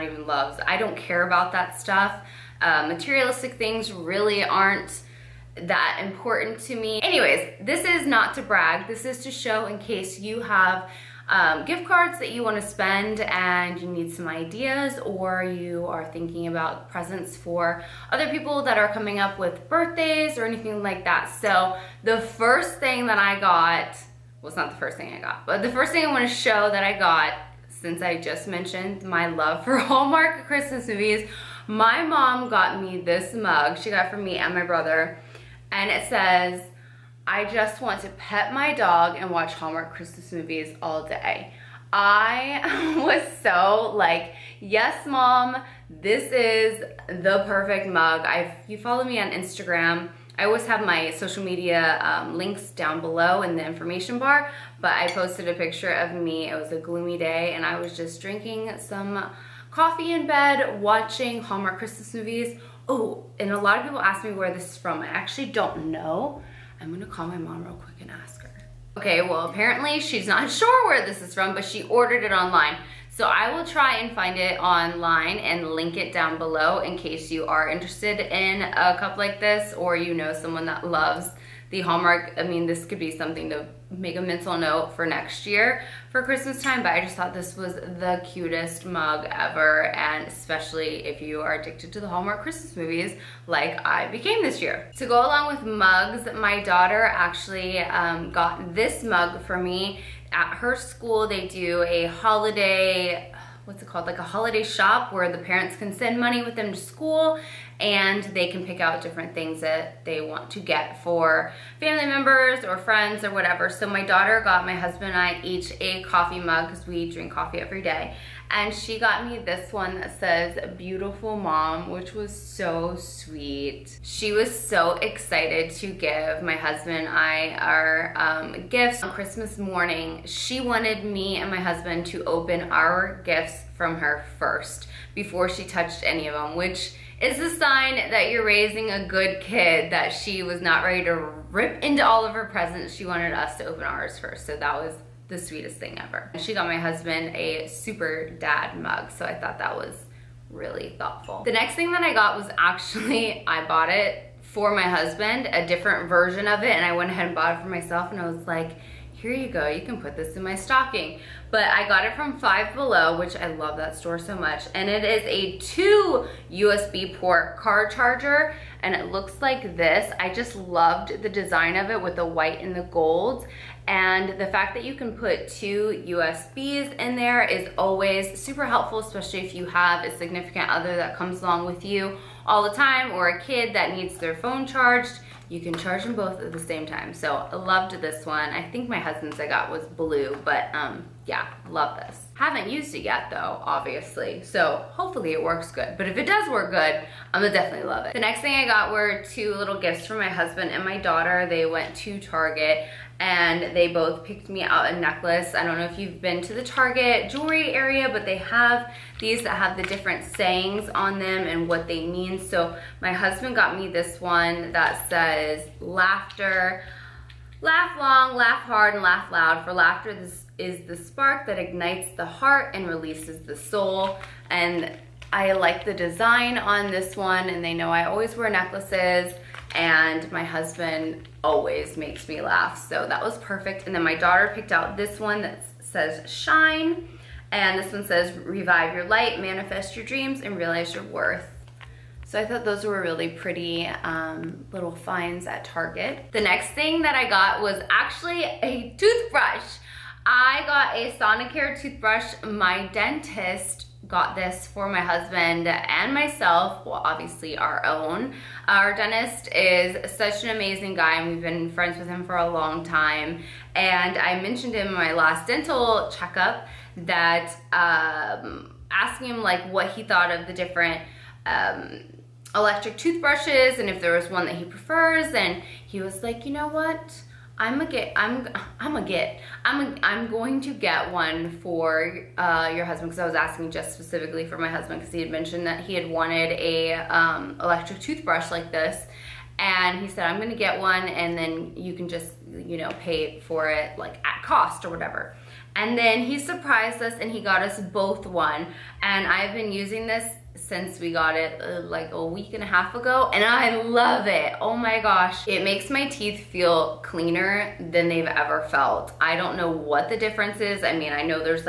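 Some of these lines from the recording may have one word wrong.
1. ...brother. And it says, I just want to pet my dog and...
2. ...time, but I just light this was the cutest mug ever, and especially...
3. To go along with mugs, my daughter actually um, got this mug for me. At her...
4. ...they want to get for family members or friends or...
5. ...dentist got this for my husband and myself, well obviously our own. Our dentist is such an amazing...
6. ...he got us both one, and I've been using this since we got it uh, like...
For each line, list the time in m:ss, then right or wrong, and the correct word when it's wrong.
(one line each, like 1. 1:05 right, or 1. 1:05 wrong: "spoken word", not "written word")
1. 0:34 right
2. 1:26 wrong: "thought", not "light"
3. 1:34 right
4. 1:50 right
5. 4:12 right
6. 4:57 right.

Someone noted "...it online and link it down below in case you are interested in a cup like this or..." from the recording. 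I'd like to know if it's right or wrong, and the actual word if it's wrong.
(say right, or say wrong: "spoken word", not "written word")
right.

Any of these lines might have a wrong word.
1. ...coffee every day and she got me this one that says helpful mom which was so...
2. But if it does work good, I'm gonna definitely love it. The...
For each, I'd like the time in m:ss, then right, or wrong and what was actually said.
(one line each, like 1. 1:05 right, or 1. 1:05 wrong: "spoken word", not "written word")
1. 1:57 wrong: "beautiful", not "helpful"
2. 3:15 right.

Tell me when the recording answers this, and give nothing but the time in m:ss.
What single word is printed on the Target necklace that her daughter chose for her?
3:56.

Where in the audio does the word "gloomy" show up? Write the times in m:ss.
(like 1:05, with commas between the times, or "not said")
0:56.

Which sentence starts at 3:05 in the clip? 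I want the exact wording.
You can charge them both at the same time.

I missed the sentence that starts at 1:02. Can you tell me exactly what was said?
Oh, and a lot of people ask me where this is from.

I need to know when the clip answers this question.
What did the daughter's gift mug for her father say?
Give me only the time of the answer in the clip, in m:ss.
2:27.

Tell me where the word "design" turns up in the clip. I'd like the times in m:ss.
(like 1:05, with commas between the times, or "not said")
2:51, 3:45.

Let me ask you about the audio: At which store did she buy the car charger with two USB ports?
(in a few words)
Five Below.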